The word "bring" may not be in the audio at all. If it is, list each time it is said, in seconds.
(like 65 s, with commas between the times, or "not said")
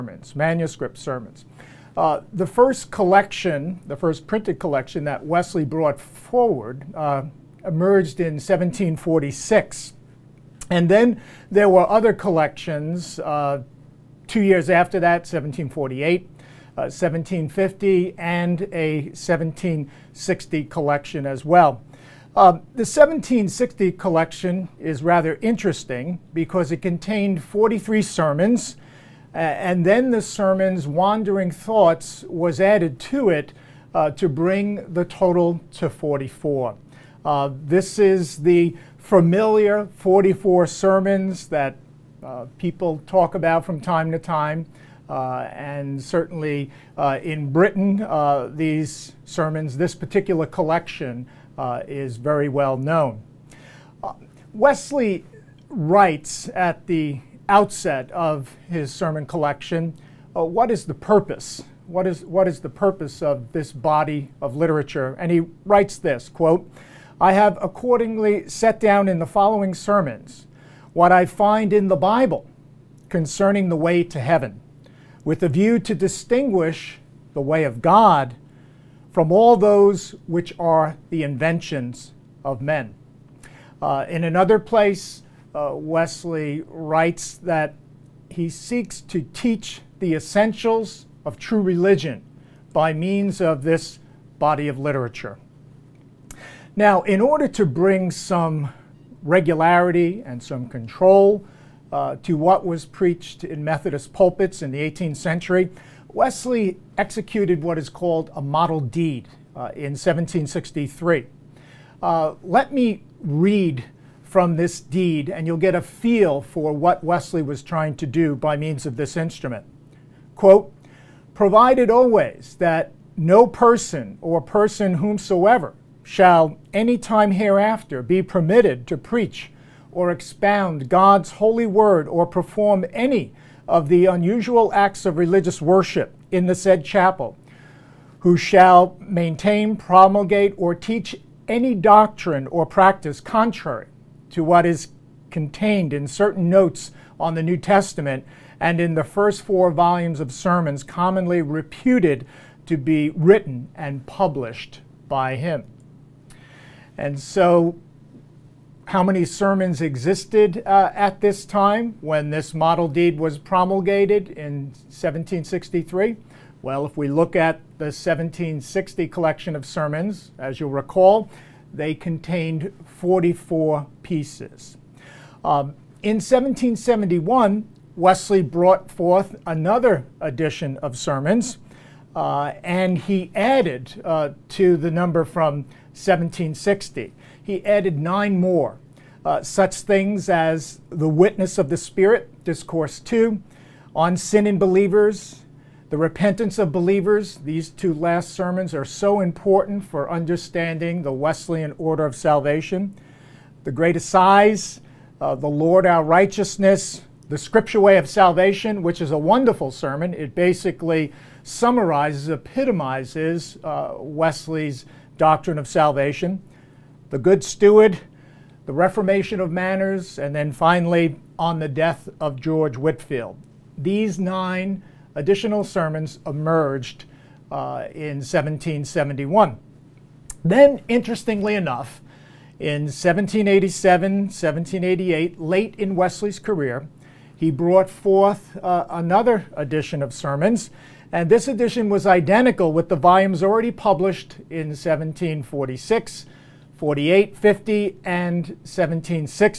34 s, 97 s.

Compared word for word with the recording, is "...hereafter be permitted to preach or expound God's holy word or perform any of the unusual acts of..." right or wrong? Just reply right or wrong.
right.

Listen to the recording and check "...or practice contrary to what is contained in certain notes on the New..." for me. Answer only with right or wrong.
right.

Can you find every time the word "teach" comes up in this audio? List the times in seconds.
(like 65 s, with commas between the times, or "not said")
89 s, 140 s.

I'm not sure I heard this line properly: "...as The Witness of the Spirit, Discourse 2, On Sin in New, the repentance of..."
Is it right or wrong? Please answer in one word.
wrong.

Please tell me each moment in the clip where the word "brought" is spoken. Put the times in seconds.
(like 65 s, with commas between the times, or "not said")
5 s, 178 s, 237 s.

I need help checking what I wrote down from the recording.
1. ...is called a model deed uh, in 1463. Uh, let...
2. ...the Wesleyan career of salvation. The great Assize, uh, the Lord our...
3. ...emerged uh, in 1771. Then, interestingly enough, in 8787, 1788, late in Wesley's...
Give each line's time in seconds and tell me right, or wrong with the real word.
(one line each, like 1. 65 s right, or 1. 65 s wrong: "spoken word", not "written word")
1. 107 s wrong: "1763", not "1463"
2. 201 s wrong: "order", not "career"
3. 226 s wrong: "1787", not "8787".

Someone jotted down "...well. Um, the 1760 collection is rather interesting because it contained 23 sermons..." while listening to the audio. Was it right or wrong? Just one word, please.
wrong.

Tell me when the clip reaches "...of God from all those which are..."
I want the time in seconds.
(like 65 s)
77 s.